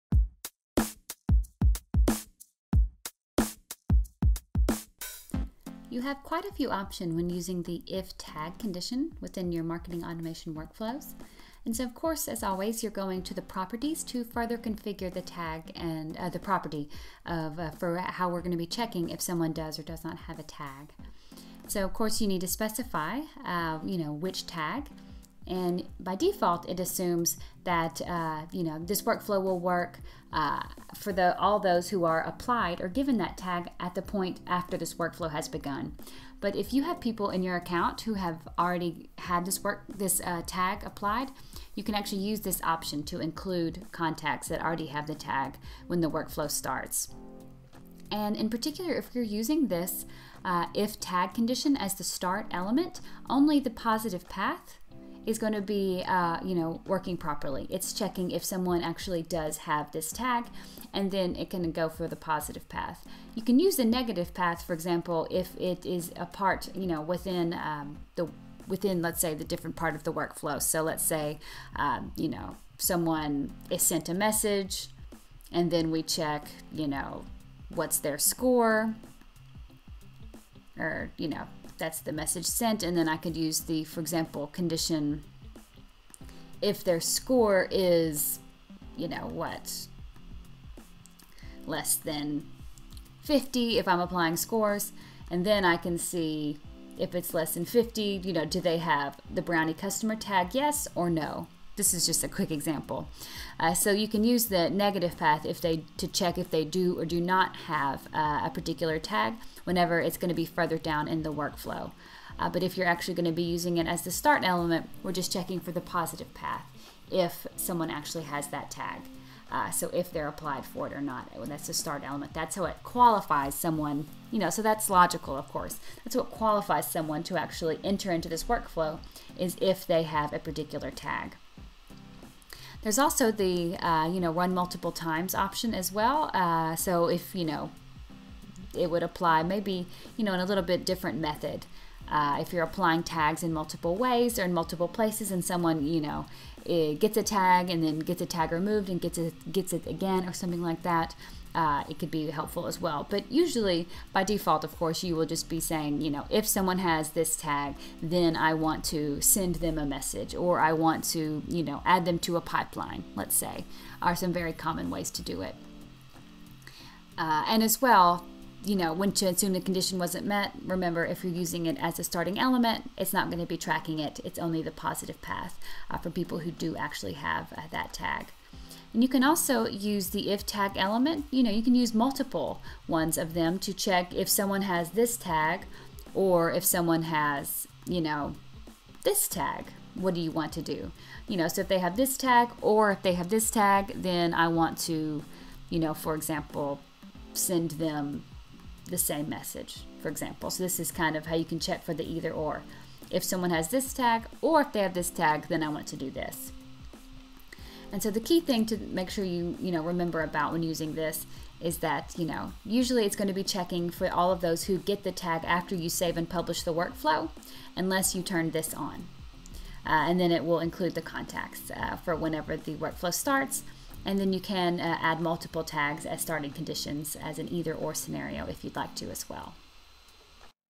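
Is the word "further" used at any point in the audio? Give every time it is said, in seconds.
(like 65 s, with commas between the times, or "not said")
14 s, 110 s.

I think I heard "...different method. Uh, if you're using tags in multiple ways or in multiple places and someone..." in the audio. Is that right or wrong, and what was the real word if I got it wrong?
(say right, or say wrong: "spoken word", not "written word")
wrong: "applying", not "using".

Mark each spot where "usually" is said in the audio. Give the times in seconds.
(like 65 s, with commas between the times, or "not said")
153 s, 212 s.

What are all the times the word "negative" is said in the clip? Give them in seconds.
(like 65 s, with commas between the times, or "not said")
63 s, 104 s.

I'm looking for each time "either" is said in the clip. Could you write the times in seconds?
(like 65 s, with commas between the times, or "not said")
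202 s, 227 s.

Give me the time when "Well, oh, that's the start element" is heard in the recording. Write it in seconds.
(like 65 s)
121 s.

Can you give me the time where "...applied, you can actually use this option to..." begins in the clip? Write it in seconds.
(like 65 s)
40 s.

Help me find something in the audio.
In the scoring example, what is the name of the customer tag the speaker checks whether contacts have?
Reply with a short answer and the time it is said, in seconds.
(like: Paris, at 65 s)
brownie customer, at 99 s.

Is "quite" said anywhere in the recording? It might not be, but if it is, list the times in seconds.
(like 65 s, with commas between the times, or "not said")
6 s.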